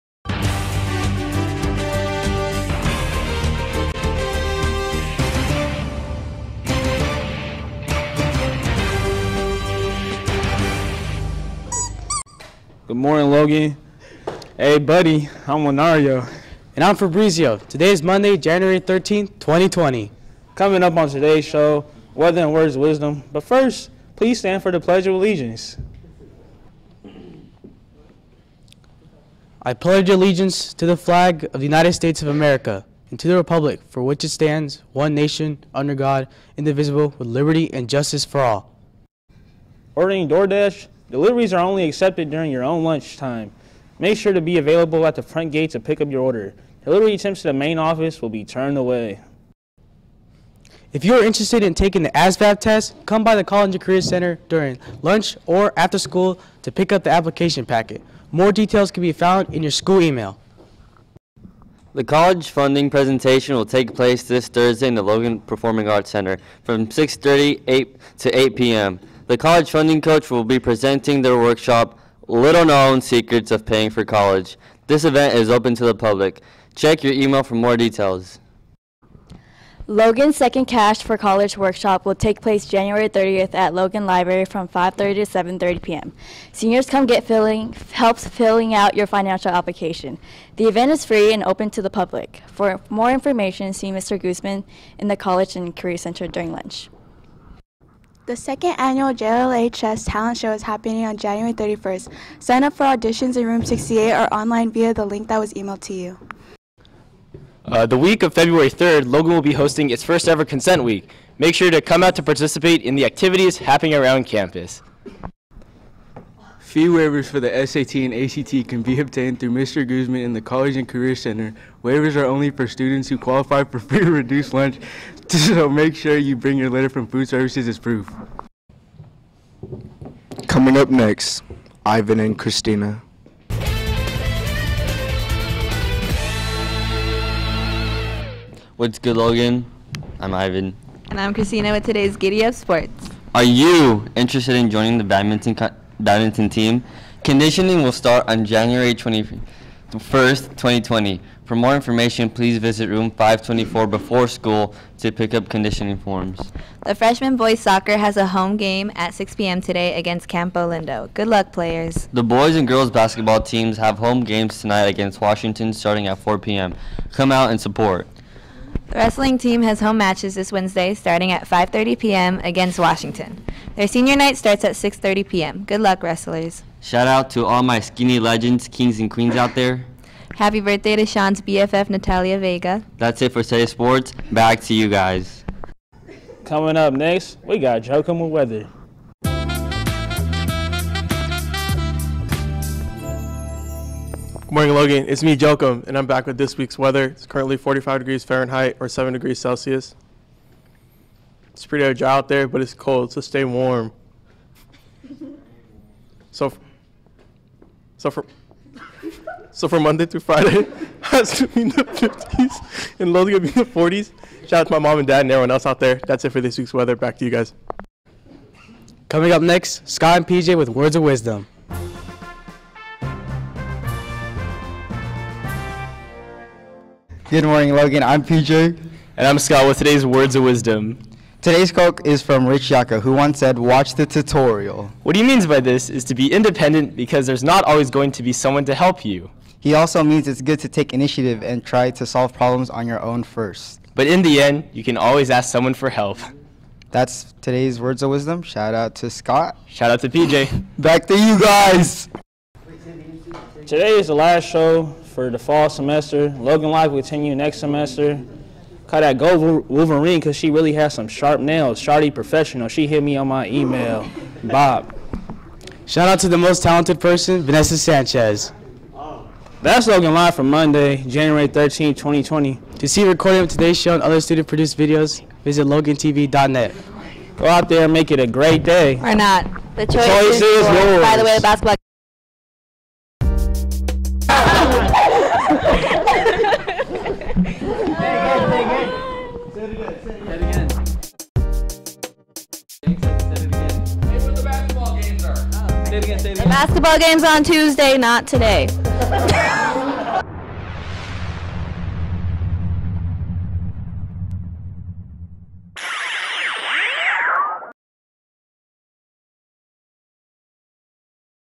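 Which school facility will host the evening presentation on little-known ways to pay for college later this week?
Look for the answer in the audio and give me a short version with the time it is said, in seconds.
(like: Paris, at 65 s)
Logan Performing Arts Center, at 65 s.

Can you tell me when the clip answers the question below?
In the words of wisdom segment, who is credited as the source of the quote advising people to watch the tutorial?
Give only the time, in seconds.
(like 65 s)
232 s.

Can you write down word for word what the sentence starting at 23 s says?
But first, please stand for the Pledge of Allegiance.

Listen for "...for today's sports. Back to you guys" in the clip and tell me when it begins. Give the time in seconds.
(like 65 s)
183 s.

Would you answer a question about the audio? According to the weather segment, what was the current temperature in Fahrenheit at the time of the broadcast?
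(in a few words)
45 degrees.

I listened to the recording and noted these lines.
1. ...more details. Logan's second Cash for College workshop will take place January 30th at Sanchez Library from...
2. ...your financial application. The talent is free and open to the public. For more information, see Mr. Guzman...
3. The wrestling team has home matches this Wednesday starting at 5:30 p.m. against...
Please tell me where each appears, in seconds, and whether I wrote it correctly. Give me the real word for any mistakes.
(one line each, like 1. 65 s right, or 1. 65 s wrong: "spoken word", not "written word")
1. 77 s wrong: "Logan", not "Sanchez"
2. 88 s wrong: "event", not "talent"
3. 168 s right.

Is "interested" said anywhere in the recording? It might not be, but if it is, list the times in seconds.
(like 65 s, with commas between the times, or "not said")
51 s, 144 s.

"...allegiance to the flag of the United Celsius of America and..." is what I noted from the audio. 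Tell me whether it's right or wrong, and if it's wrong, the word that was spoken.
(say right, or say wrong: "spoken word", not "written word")
wrong: "States", not "Celsius".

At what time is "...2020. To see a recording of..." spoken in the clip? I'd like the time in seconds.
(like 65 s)
271 s.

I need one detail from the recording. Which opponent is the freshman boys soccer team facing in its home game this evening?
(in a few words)
Campolindo.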